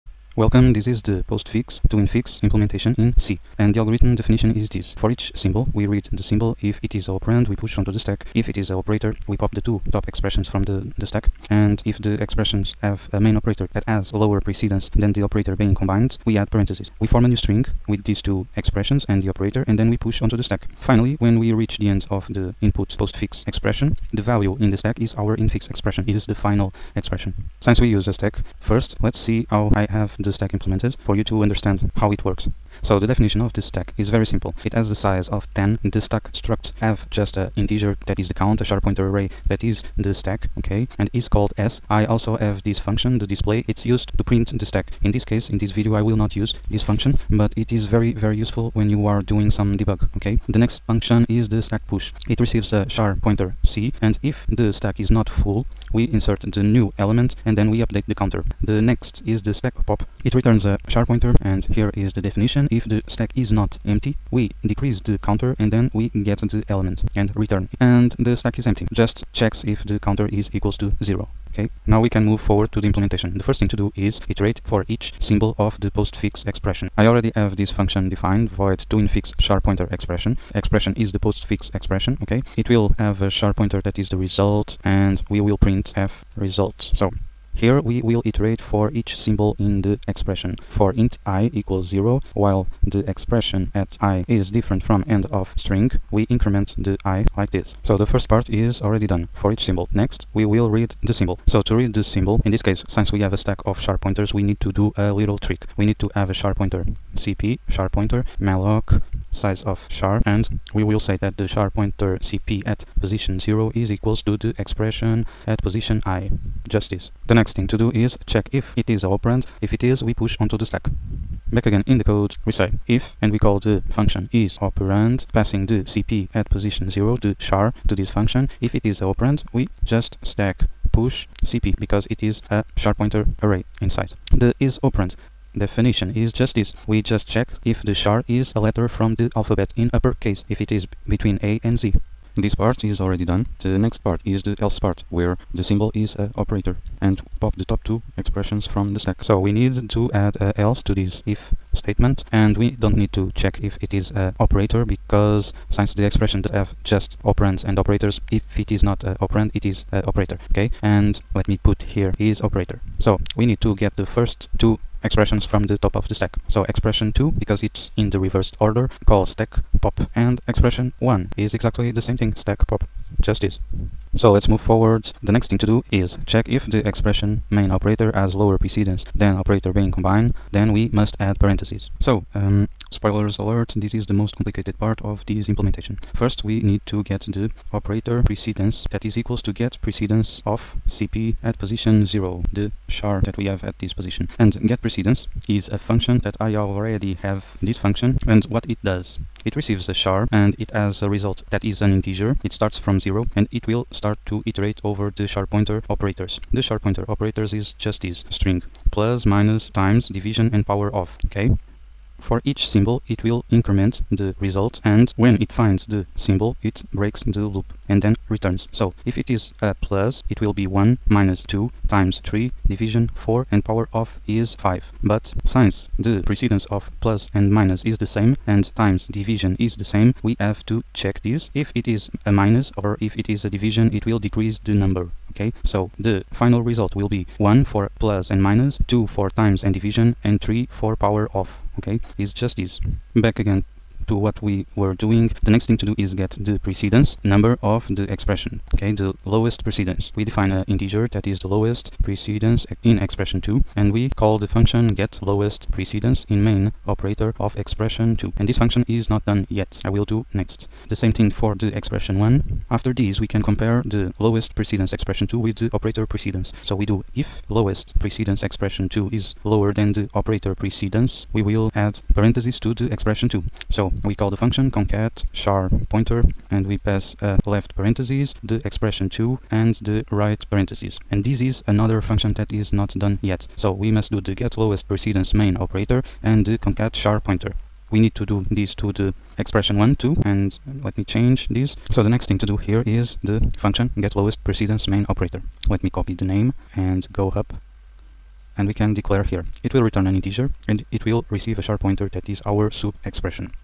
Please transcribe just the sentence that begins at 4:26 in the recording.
So we do if lowest precedence expression 2 is lower than the operator precedence, we will add parentheses to the expression 2.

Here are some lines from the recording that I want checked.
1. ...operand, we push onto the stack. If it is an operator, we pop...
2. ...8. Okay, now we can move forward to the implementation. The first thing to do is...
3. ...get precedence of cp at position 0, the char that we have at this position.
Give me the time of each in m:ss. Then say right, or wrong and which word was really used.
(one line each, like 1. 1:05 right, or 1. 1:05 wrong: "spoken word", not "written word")
1. 0:07 right
2. 1:11 wrong: "0", not "8"
3. 3:09 right.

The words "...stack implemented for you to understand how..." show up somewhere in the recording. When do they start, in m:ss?
0:30.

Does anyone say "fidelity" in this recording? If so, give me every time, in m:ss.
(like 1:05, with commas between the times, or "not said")
not said.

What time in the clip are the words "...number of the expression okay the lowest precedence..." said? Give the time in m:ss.
4:07.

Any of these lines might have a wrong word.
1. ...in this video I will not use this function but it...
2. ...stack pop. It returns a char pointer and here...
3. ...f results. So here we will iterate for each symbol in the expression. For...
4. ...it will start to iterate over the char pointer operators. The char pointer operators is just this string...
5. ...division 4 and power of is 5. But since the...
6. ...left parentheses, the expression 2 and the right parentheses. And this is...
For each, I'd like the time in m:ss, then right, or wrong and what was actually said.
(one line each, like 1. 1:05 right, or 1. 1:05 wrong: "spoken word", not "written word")
1. 0:45 right
2. 0:59 right
3. 1:25 right
4. 3:23 right
5. 3:42 right
6. 4:37 right.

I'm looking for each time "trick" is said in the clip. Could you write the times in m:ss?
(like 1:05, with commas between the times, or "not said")
1:45.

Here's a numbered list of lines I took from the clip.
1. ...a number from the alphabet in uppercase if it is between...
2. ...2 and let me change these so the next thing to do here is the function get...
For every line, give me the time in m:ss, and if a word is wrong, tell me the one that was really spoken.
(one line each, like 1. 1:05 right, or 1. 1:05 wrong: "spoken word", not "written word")
1. 2:18 wrong: "letter", not "number"
2. 4:49 right.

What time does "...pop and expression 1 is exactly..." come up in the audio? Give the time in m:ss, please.
2:49.